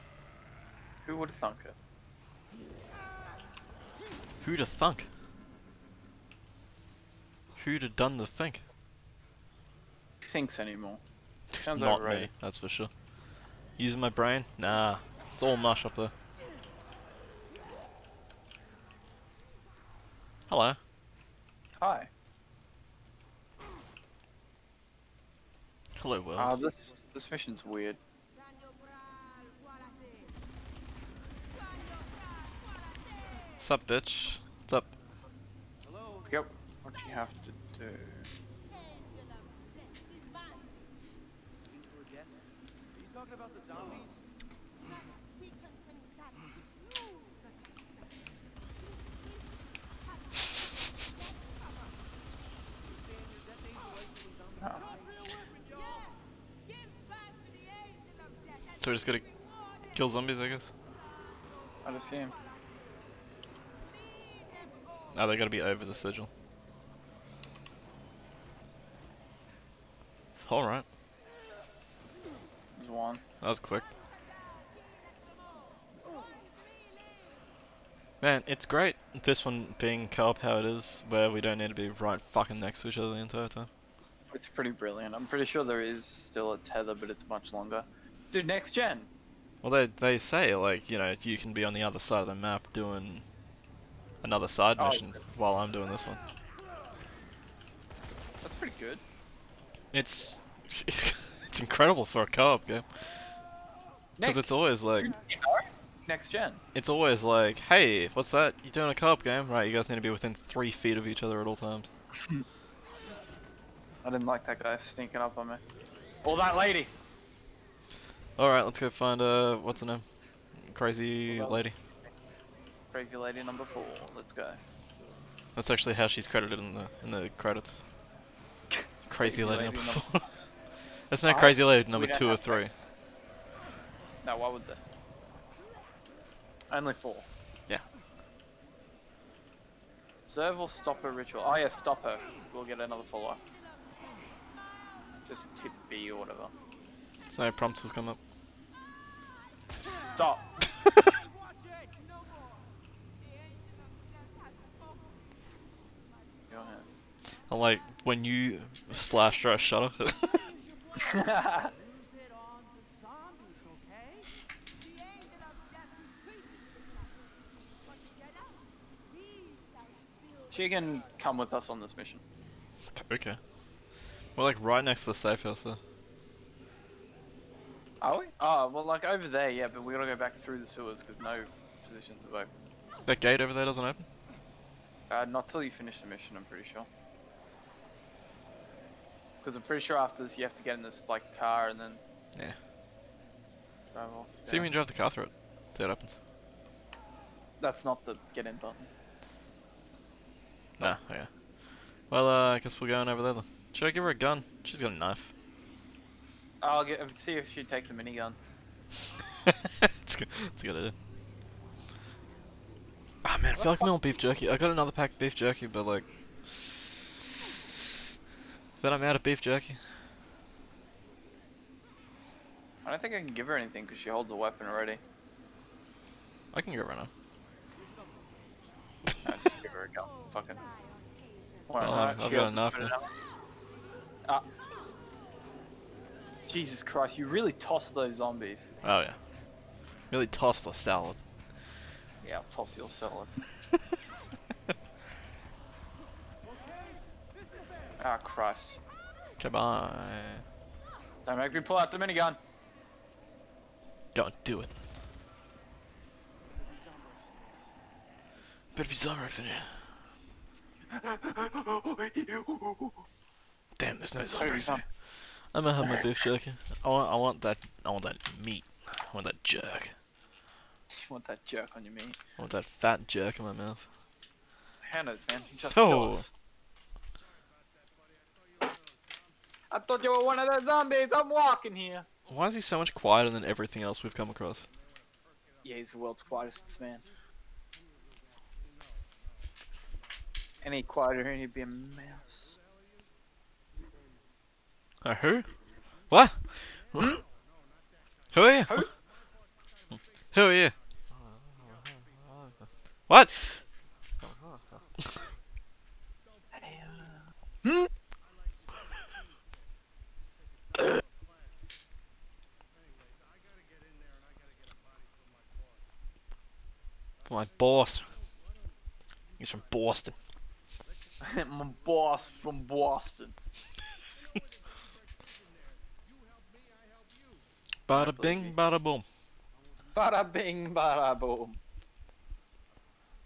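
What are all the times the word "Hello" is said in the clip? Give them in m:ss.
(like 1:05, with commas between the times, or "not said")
0:20, 0:26, 0:35.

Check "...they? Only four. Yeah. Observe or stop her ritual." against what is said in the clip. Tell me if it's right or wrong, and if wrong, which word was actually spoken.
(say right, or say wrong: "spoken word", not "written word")
right.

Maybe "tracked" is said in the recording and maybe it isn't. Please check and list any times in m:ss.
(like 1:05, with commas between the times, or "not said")
not said.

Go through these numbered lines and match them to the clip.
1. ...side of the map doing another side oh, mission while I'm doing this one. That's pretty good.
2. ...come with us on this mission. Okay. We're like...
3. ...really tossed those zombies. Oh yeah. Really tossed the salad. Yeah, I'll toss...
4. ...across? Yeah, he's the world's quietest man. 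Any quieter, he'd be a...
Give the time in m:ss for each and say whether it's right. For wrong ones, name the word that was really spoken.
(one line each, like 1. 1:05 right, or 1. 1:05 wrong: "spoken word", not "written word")
1. 1:31 right
2. 2:51 right
3. 3:57 right
4. 4:44 right.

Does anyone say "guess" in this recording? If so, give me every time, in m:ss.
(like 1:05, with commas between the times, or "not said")
1:00, 3:22.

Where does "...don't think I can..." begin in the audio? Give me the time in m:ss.
3:42.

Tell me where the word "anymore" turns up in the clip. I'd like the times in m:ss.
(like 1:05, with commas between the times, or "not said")
0:10.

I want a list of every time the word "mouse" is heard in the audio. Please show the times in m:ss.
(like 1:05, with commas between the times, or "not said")
4:51.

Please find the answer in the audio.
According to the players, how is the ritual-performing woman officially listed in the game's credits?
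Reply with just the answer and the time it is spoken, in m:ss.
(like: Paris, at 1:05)
Crazy lady number four, at 2:02.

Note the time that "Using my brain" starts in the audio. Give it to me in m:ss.
0:13.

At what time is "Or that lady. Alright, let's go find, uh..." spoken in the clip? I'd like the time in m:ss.
1:56.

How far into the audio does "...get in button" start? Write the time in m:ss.
3:18.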